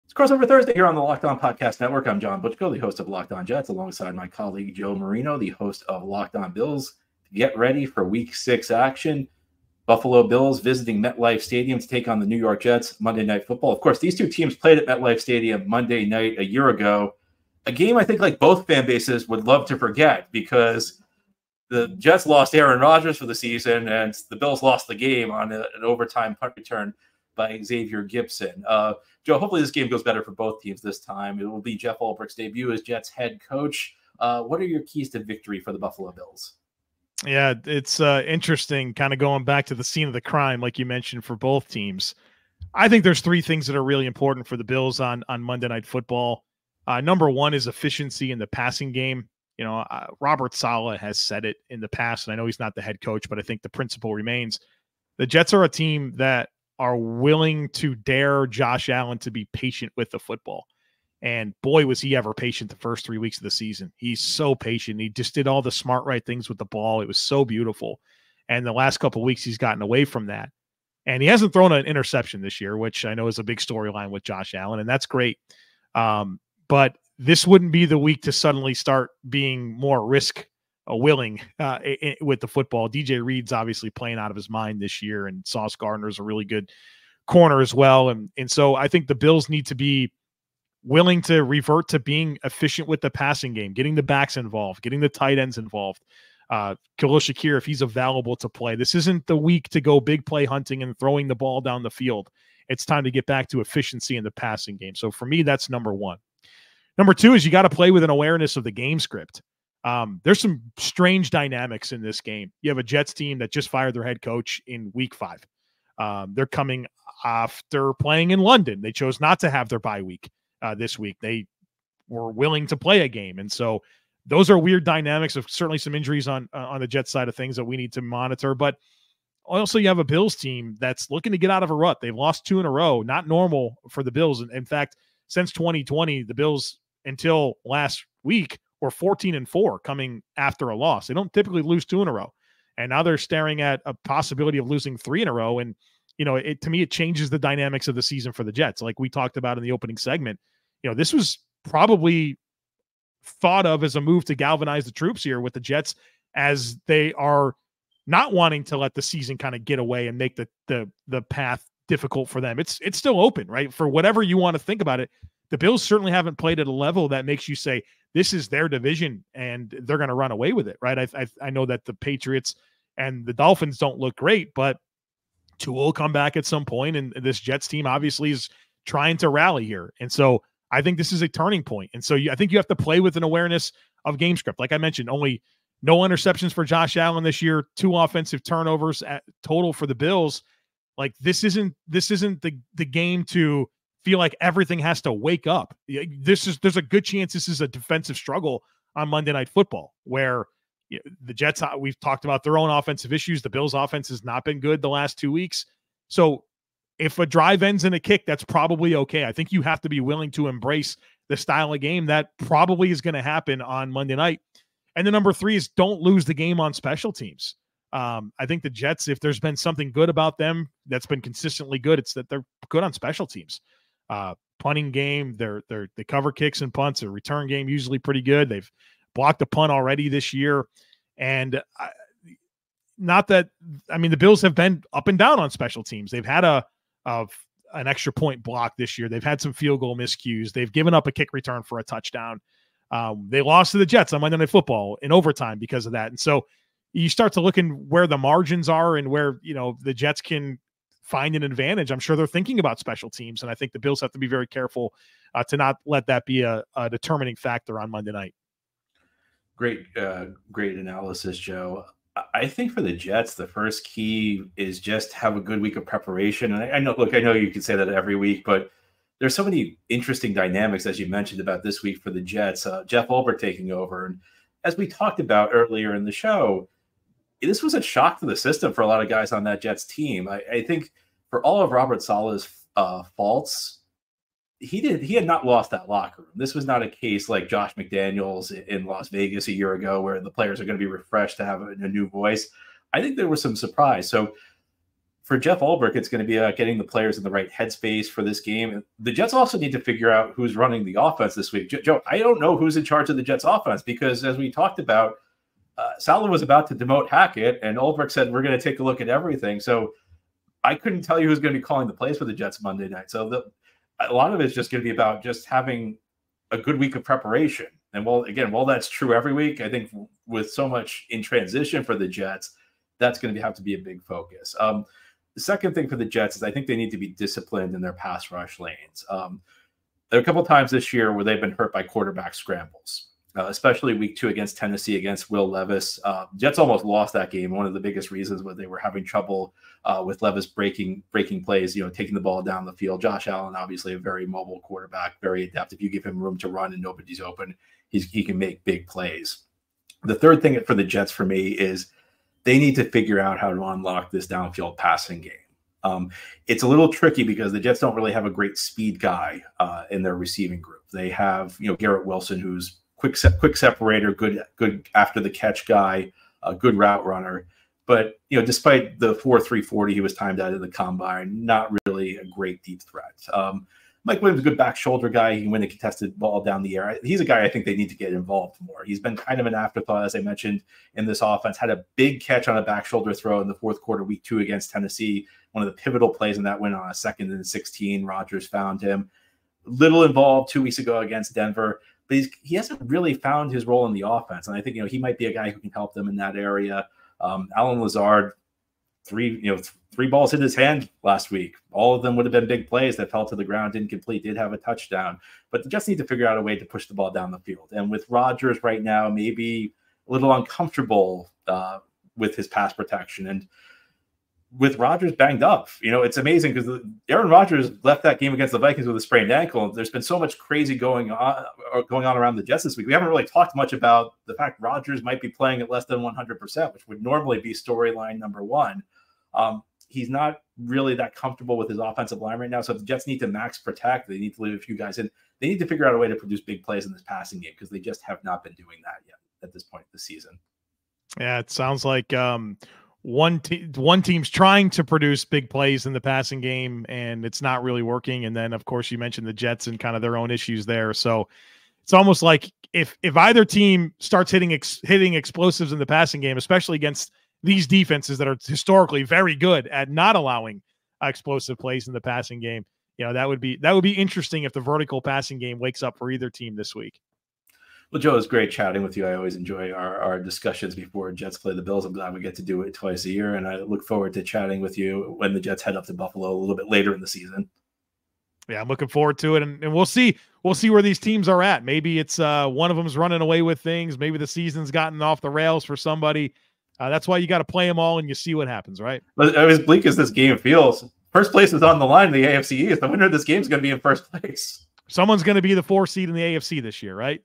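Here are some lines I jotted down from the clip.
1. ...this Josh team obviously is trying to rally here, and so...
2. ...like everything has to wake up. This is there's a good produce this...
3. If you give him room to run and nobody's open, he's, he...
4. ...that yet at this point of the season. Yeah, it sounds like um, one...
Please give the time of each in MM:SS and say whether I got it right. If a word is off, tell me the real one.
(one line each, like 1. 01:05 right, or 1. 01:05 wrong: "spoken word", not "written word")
1. 02:57 wrong: "Jets", not "Josh"
2. 03:14 wrong: "chance", not "produce"
3. 05:45 right
4. 07:18 right.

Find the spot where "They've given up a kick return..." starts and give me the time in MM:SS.
04:00.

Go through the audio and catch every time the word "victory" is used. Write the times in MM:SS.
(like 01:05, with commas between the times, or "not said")
00:35.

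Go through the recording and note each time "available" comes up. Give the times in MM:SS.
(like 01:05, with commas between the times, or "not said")
01:37.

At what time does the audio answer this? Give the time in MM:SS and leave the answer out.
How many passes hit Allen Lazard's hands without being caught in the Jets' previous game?
06:39.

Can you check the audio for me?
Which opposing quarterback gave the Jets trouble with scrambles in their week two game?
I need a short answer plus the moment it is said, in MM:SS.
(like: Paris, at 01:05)
Will Levis, at 05:35.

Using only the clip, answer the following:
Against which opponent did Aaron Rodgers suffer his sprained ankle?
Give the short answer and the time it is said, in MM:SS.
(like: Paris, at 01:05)
Vikings, at 06:58.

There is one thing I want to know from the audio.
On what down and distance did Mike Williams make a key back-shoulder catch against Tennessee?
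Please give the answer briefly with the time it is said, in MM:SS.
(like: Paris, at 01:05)
2nd and 16, at 06:26.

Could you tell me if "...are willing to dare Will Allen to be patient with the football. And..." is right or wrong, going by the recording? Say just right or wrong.
wrong.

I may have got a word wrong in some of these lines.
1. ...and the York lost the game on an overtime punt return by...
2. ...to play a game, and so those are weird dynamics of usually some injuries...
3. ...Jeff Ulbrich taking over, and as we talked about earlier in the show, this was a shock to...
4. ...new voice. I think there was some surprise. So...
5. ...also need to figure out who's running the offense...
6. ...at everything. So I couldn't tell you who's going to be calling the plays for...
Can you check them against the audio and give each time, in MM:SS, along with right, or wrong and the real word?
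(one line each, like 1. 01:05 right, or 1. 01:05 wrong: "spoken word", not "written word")
1. 00:23 wrong: "Bills", not "York"
2. 02:02 wrong: "certainly", not "usually"
3. 04:32 right
4. 04:51 right
5. 04:59 right
6. 05:09 right.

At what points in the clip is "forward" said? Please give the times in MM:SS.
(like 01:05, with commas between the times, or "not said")
07:53, 07:58.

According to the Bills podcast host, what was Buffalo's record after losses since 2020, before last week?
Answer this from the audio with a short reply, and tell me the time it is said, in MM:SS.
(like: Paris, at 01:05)
14-4, at 02:18.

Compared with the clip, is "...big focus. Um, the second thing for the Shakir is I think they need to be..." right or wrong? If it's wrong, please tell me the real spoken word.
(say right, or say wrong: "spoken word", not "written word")
wrong: "Jets", not "Shakir".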